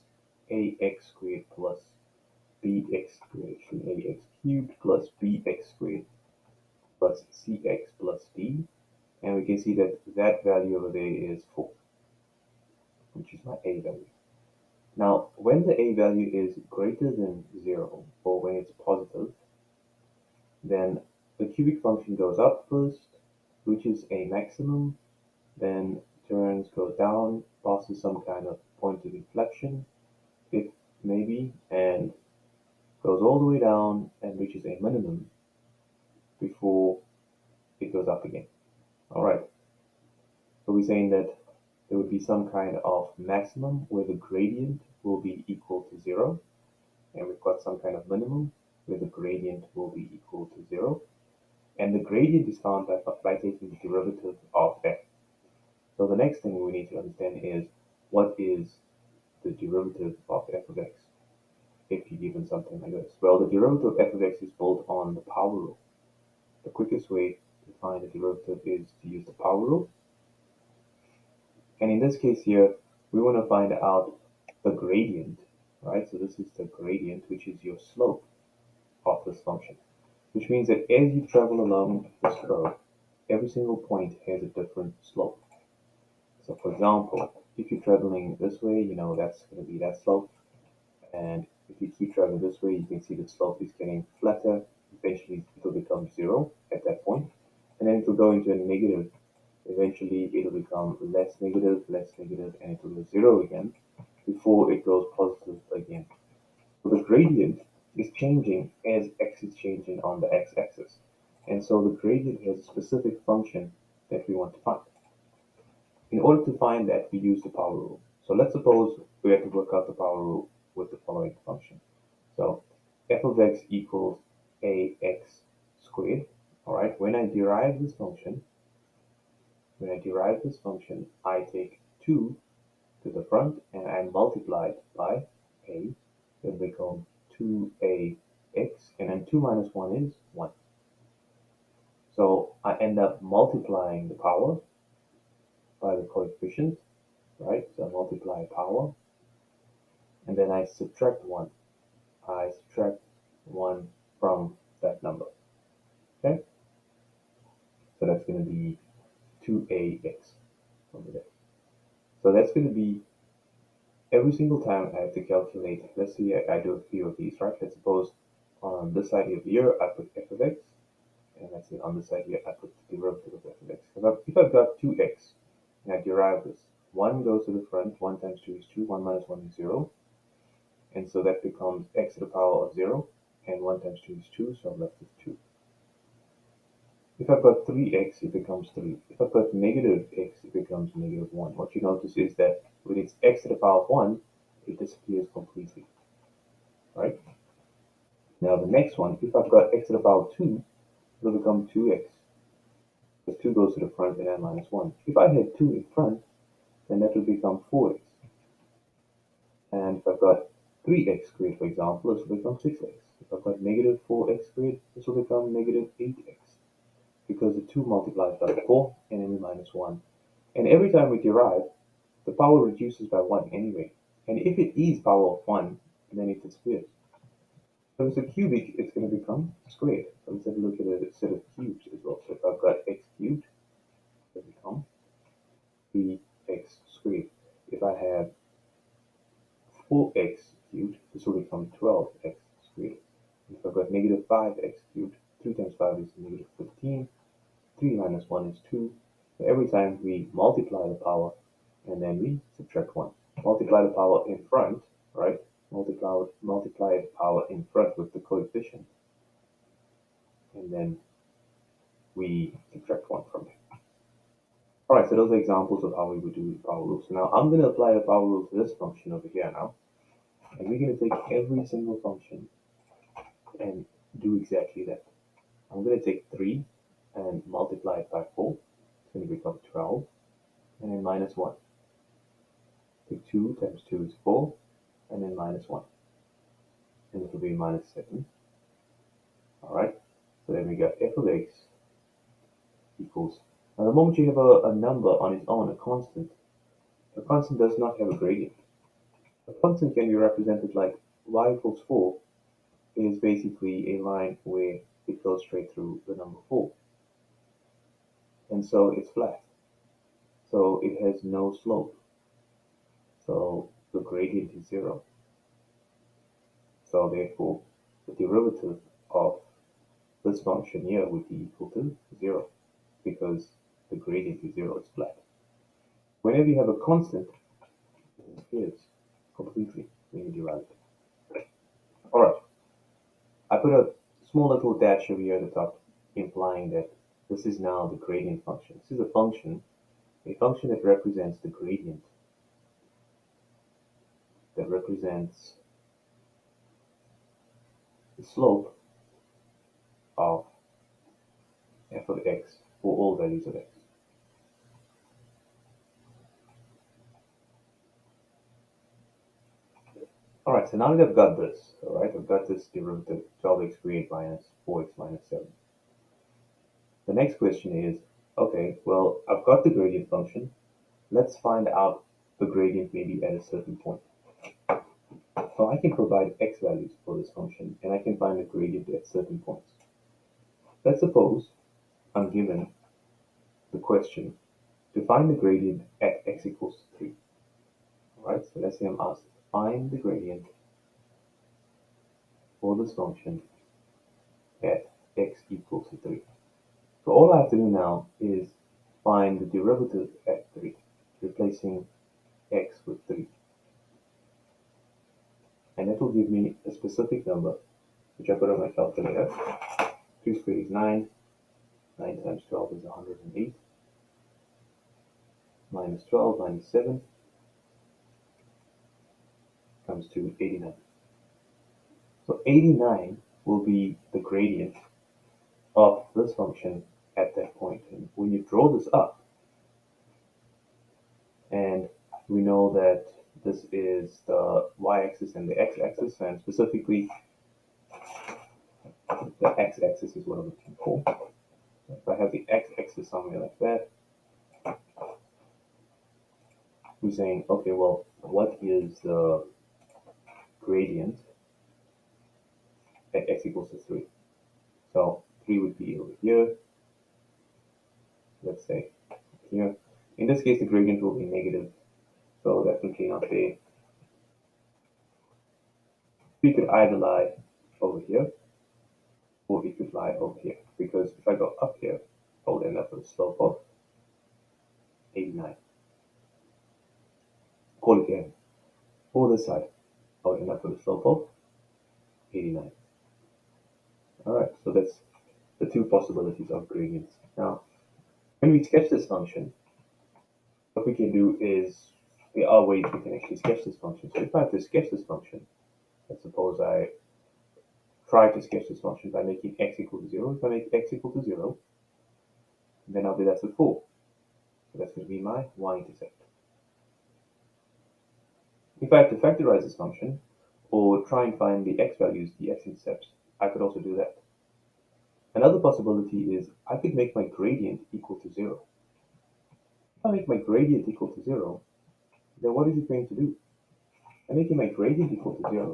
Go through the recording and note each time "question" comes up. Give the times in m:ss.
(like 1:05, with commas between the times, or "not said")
6:07, 6:23.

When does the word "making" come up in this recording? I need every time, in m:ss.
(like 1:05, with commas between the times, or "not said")
8:19, 8:44.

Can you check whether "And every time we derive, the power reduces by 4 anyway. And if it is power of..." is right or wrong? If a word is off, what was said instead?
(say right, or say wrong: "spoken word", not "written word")
wrong: "1", not "4".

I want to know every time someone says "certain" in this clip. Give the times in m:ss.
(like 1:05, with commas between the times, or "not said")
6:13, 6:19.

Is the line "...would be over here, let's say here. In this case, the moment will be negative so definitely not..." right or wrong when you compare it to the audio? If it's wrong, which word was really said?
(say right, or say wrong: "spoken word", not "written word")
wrong: "gradient", not "moment".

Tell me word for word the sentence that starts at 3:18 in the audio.
Now the next one, if I've got x to the power 2, it'll become 2x.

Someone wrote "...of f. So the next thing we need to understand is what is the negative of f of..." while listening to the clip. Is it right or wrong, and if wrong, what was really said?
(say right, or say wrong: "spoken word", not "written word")
wrong: "derivative", not "negative".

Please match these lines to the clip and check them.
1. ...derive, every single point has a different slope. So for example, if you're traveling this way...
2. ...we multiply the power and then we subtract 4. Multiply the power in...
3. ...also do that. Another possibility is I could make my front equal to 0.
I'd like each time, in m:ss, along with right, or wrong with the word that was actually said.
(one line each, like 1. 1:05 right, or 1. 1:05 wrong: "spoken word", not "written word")
1. 1:22 wrong: "curve", not "derive"
2. 4:10 wrong: "1", not "4"
3. 8:33 wrong: "gradient", not "front".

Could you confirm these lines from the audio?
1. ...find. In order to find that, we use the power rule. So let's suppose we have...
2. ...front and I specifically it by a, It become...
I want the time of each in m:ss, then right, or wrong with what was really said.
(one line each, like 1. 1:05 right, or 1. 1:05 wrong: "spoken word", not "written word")
1. 1:54 right
2. 2:13 wrong: "multiply", not "specifically".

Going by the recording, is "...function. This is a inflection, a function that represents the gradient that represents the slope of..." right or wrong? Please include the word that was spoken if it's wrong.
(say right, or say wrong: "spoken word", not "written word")
wrong: "function", not "inflection".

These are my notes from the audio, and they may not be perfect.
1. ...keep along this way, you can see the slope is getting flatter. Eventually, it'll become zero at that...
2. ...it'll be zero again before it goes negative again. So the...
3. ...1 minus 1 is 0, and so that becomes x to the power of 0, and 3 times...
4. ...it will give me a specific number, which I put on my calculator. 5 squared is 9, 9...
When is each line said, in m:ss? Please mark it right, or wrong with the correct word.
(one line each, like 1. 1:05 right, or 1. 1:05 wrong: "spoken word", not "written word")
1. 1:31 wrong: "traveling", not "along"
2. 1:42 wrong: "positive", not "negative"
3. 2:58 wrong: "1", not "3"
4. 6:45 wrong: "2", not "5".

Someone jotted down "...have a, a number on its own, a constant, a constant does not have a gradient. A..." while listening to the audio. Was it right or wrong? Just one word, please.
right.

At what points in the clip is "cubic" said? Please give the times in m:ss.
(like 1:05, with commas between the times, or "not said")
0:21, 3:48.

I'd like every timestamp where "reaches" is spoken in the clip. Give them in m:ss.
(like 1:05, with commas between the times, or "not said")
0:23, 0:34.